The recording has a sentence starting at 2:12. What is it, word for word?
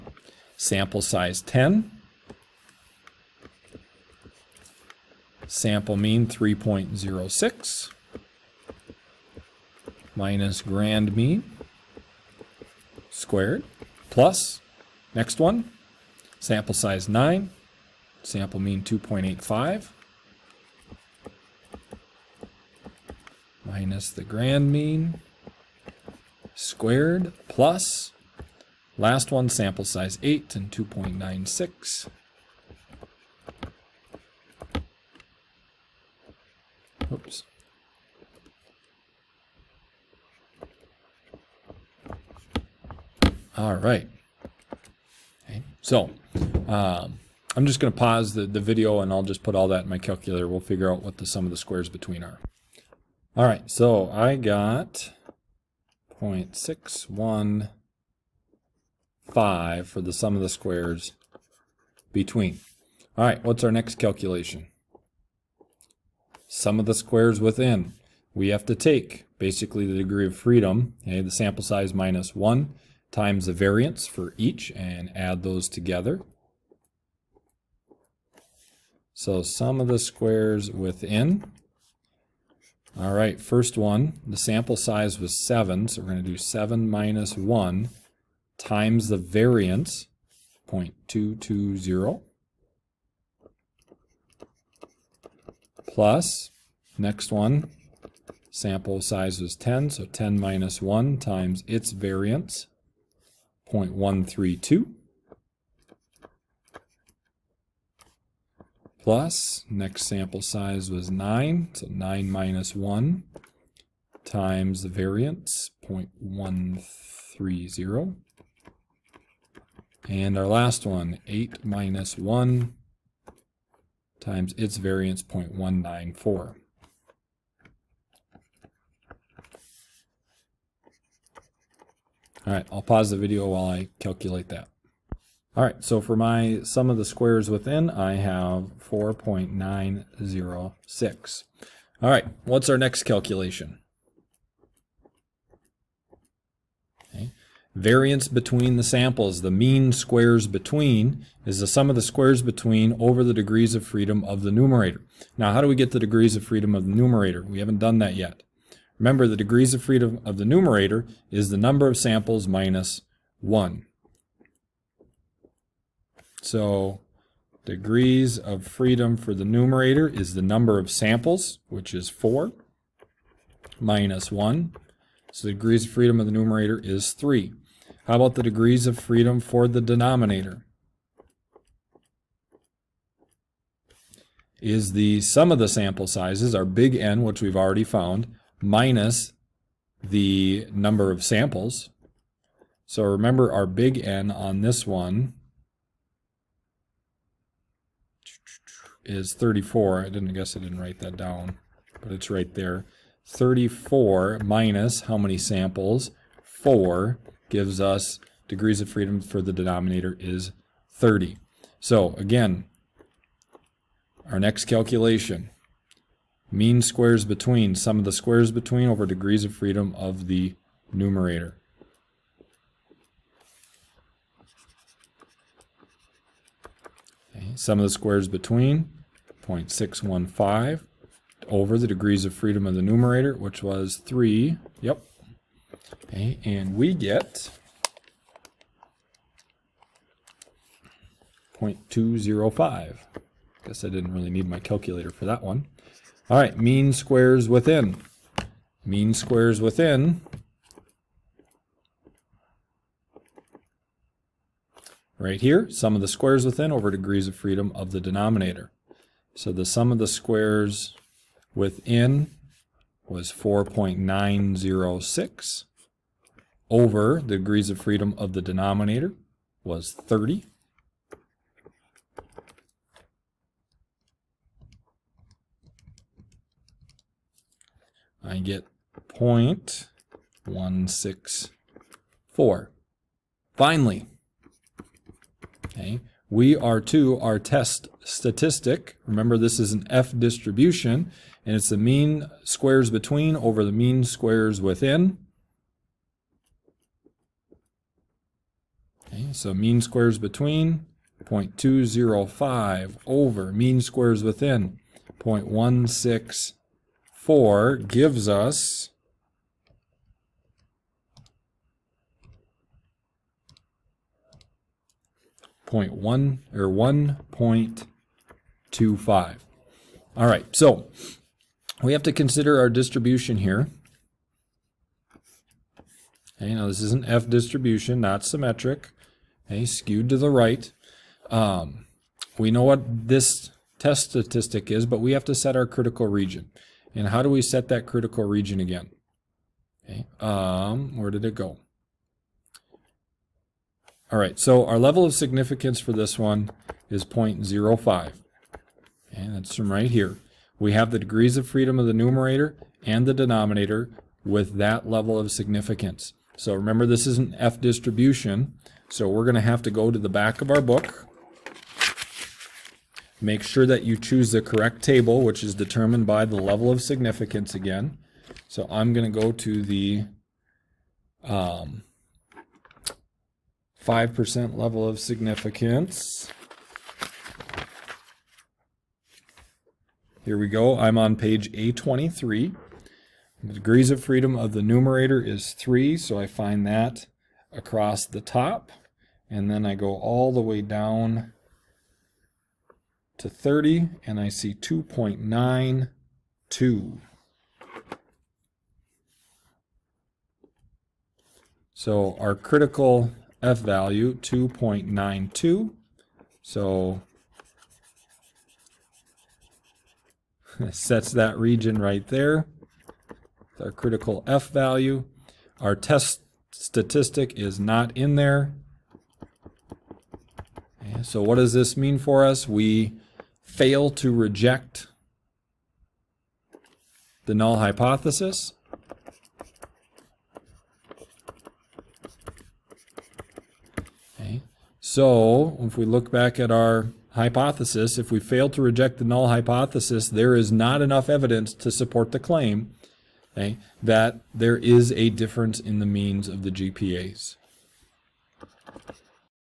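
All right, I'll pause the video while I calculate that.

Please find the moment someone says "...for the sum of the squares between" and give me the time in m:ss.
0:59.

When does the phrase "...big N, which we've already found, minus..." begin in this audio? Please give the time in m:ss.
3:06.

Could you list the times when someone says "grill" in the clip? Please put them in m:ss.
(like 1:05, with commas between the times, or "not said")
not said.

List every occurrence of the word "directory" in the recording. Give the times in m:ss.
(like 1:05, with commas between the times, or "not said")
not said.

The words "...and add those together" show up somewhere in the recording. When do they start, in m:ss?
1:14.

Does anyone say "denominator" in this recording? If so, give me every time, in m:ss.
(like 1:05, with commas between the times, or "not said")
2:59, 3:29, 4:17, 4:28, 5:53.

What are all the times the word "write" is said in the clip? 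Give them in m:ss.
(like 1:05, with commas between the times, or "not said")
3:20.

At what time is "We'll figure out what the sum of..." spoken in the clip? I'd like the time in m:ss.
0:50.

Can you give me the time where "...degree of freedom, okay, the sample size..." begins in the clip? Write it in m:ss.
1:09.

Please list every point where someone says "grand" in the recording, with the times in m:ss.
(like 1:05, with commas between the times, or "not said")
0:10, 0:24.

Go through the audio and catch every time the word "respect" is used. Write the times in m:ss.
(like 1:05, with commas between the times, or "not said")
not said.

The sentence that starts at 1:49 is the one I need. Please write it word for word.
plus next sample size was 9, so 9 minus 1 times the variance 0.130.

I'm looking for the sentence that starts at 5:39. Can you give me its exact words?
Okay, um, where did it go?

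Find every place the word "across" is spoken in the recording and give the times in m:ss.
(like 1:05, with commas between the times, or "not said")
6:27.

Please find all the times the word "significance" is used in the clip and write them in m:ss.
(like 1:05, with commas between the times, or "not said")
5:45, 5:55, 6:06, 6:14.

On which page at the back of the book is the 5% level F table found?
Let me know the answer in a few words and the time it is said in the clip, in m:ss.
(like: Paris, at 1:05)
A23, at 6:21.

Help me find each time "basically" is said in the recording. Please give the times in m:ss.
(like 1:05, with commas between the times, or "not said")
1:09.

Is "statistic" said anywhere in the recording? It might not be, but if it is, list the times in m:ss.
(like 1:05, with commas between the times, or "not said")
4:48, 5:34, 6:56.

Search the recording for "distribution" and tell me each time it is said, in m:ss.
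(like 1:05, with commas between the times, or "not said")
4:50, 5:22, 5:27, 5:57.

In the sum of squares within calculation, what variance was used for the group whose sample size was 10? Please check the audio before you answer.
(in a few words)
0.132.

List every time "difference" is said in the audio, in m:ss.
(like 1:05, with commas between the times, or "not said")
7:25.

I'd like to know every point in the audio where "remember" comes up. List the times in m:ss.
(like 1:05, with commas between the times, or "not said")
2:38, 3:13, 4:49, 5:56.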